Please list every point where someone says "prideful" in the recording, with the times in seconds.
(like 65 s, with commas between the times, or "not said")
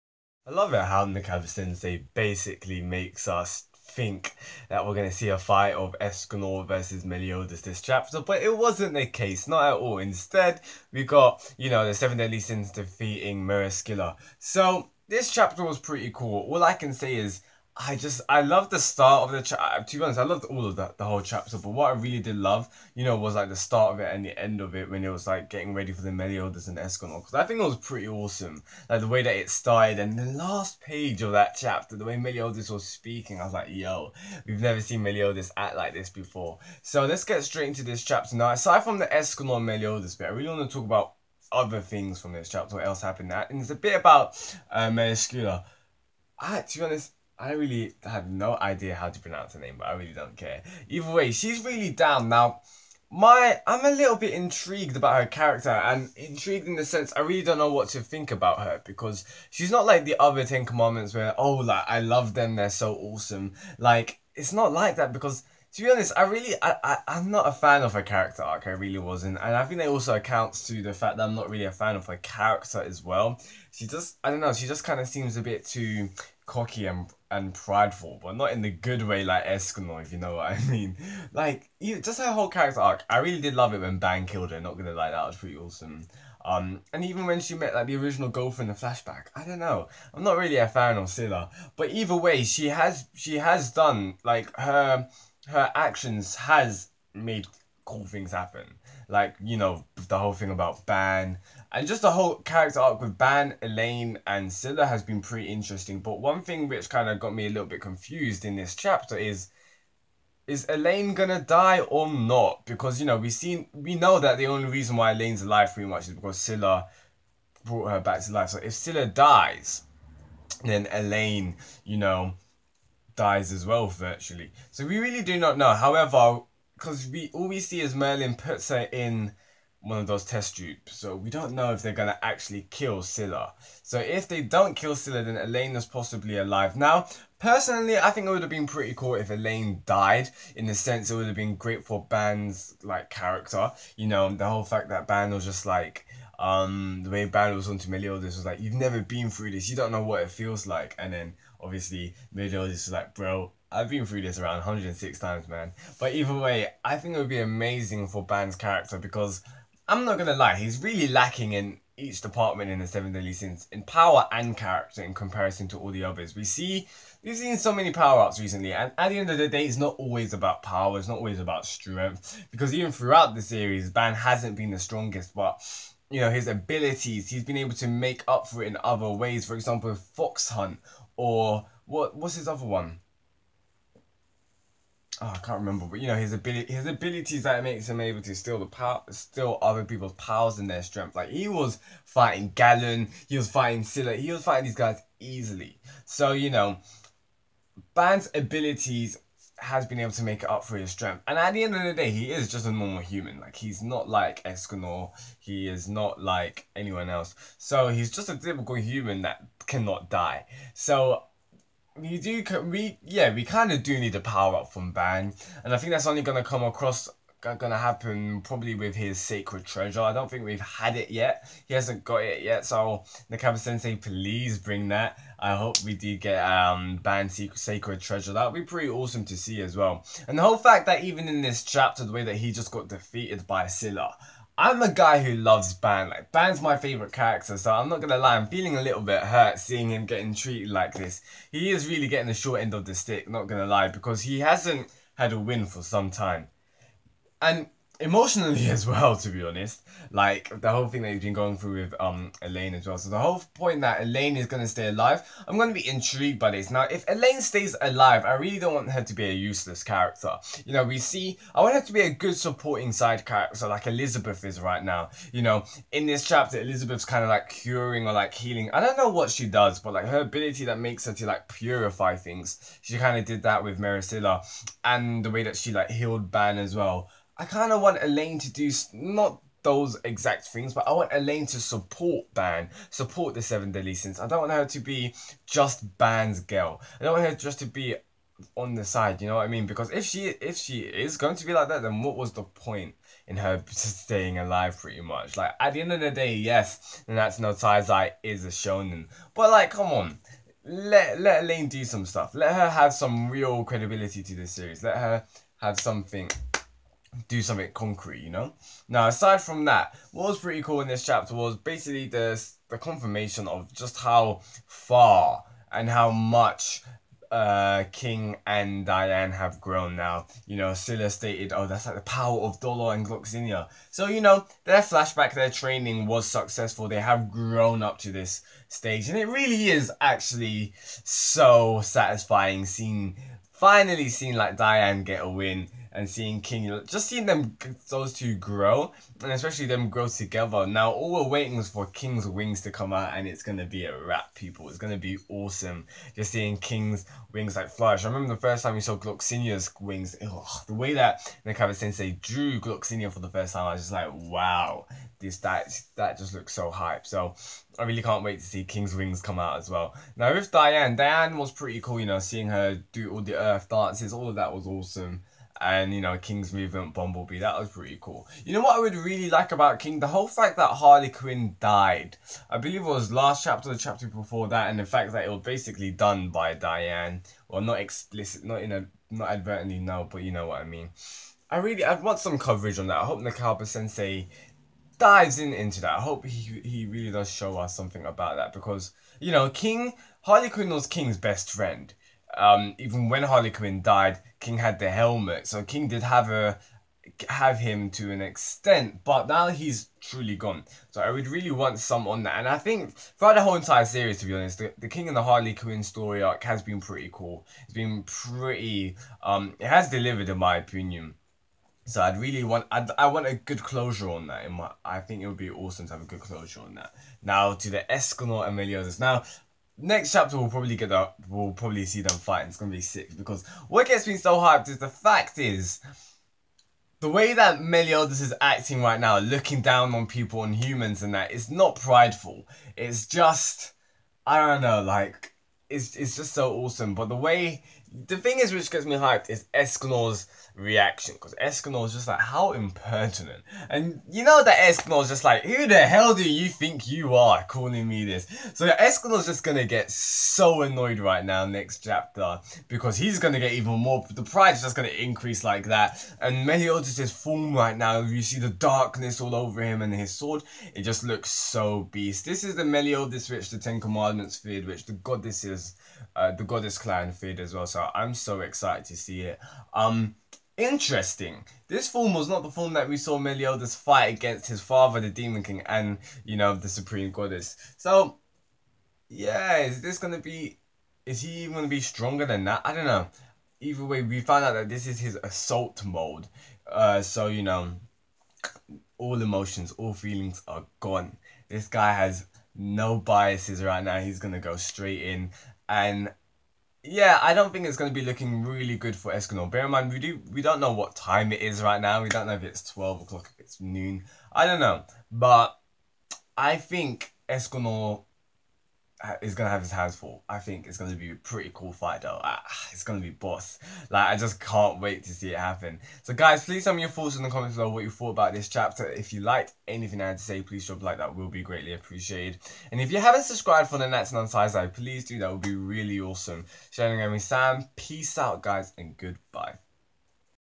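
77 s, 431 s.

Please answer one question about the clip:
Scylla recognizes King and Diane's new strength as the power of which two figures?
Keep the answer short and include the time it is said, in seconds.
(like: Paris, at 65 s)
Dolor and Gloxinia, at 322 s.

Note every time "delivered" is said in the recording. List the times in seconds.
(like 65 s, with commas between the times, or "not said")
409 s.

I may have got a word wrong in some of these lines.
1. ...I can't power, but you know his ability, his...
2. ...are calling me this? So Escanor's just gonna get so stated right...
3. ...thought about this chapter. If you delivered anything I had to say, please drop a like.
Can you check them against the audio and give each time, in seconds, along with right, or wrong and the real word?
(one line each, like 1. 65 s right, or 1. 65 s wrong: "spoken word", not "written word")
1. 185 s wrong: "remember", not "power"
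2. 447 s wrong: "annoyed", not "stated"
3. 517 s wrong: "liked", not "delivered".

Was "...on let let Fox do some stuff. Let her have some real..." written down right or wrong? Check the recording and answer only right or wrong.
wrong.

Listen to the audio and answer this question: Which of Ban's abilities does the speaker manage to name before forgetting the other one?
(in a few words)
Fox Hunt.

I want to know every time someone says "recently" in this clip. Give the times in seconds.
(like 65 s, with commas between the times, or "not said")
168 s.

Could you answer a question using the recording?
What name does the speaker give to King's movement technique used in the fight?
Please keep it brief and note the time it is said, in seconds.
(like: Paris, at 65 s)
Bumblebee, at 366 s.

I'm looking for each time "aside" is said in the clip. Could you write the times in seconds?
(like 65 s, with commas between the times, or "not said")
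38 s, 309 s.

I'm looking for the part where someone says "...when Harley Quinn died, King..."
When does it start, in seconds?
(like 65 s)
393 s.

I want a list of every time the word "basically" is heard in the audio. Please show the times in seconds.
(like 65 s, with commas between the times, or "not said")
2 s, 311 s, 375 s.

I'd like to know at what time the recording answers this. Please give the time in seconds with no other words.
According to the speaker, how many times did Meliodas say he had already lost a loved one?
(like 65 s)
154 s.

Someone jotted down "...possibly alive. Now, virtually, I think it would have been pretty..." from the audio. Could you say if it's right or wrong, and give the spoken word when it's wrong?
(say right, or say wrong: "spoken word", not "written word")
wrong: "personally", not "virtually".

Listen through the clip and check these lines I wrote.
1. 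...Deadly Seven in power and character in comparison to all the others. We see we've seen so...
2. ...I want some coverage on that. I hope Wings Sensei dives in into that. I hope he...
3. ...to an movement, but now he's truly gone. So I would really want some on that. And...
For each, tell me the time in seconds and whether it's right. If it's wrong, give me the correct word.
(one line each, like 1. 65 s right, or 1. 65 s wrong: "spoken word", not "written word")
1. 163 s wrong: "Sins", not "Seven"
2. 381 s wrong: "Nakaba", not "Wings"
3. 397 s wrong: "extent", not "movement".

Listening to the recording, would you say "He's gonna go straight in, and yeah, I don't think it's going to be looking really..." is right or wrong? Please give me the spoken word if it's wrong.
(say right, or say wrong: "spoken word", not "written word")
right.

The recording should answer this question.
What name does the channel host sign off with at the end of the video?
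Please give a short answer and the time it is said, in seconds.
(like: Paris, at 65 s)
Shinigami Sam, at 526 s.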